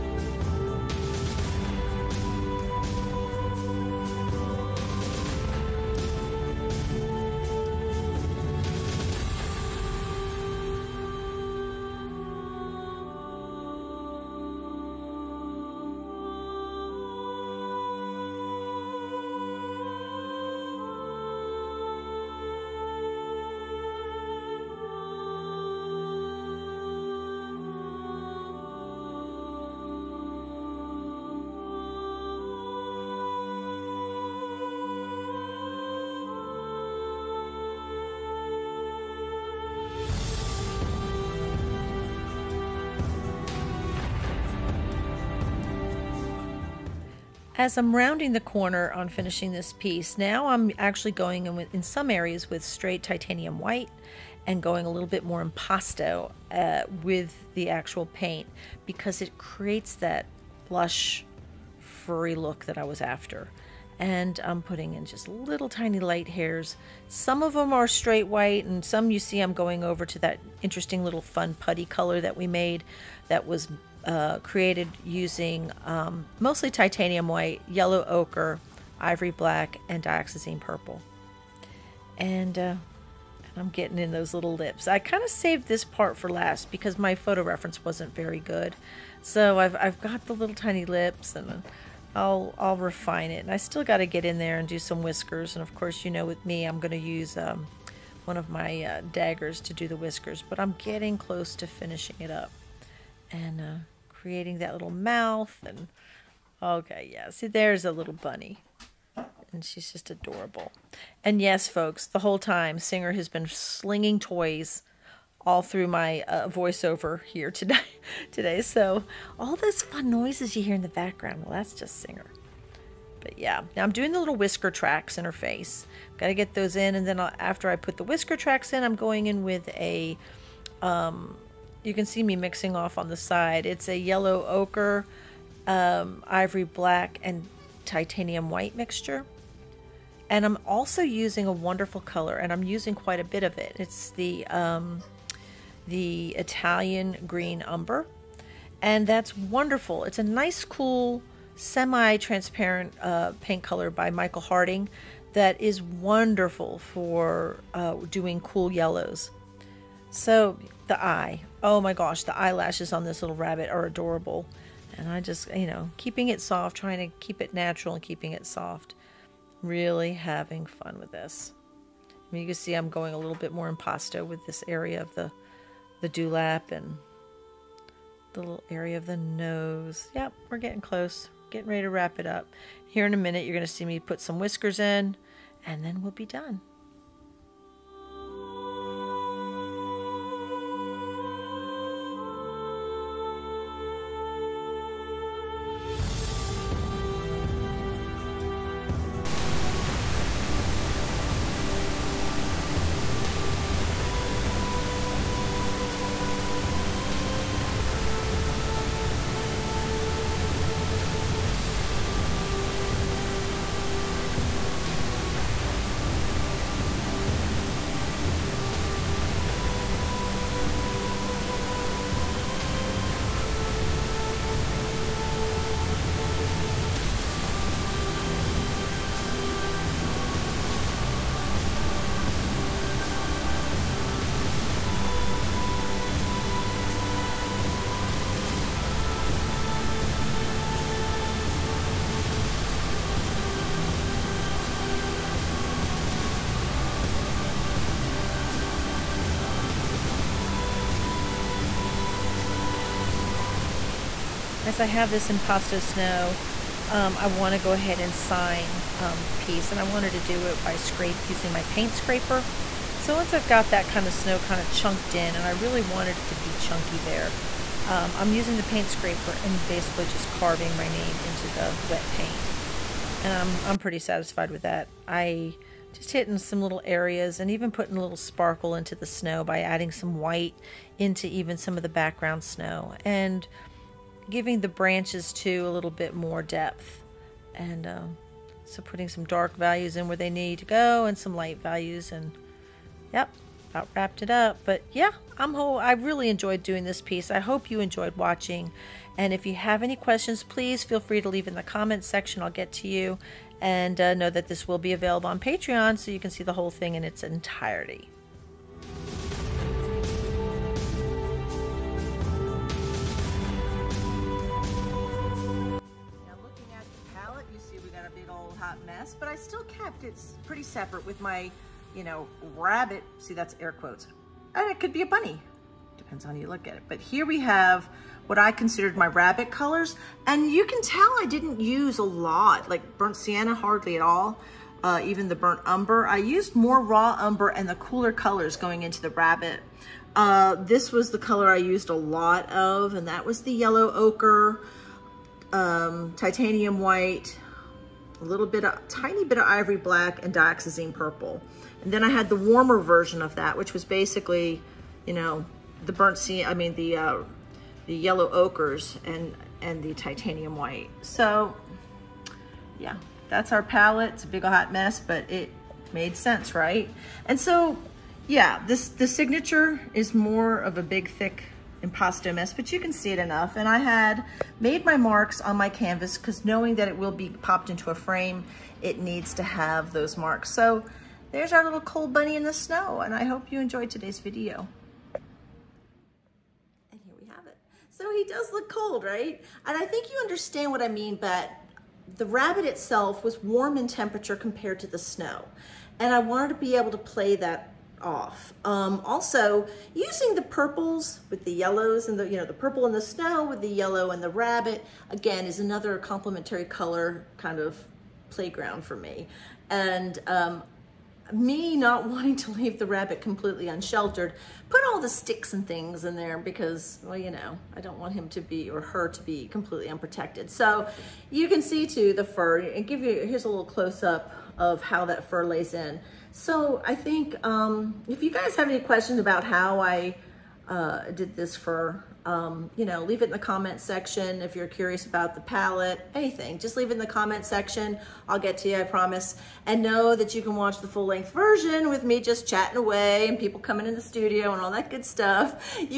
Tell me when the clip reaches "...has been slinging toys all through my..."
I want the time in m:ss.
1:53.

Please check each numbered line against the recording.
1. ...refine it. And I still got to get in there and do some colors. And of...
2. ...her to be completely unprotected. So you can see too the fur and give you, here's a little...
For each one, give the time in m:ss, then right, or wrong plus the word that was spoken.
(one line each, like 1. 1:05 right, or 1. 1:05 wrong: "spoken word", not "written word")
1. 1:32 wrong: "whiskers", not "colors"
2. 6:58 right.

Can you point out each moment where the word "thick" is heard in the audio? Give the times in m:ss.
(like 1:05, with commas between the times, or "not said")
6:11.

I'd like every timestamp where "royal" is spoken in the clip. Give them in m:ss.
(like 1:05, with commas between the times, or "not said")
not said.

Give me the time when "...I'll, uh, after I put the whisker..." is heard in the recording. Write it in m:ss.
2:07.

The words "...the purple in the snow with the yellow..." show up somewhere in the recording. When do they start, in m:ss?
6:42.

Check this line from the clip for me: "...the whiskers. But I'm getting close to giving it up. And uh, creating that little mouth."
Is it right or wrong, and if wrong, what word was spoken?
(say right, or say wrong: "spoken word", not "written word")
wrong: "finishing", not "giving".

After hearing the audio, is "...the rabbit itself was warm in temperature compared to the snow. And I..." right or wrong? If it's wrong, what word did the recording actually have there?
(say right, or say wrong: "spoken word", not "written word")
right.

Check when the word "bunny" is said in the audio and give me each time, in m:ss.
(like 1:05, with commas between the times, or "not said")
1:48, 5:25, 6:22.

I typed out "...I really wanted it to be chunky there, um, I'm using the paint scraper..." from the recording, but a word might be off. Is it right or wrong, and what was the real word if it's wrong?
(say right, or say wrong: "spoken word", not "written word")
right.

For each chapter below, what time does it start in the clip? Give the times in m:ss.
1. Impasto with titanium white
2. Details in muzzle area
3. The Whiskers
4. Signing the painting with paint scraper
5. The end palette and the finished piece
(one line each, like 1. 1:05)
1. 0:50
2. 1:50
3. 3:29
4. 4:29
5. 5:20.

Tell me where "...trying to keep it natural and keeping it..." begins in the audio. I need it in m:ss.
2:46.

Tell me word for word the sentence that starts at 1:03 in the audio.
And I'm putting in just little tiny light hairs.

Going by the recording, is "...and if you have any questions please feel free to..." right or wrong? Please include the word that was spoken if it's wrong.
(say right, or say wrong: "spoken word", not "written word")
right.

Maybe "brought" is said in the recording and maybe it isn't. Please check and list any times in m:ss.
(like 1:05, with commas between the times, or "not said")
not said.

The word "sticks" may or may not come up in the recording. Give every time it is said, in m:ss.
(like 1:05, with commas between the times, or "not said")
6:55.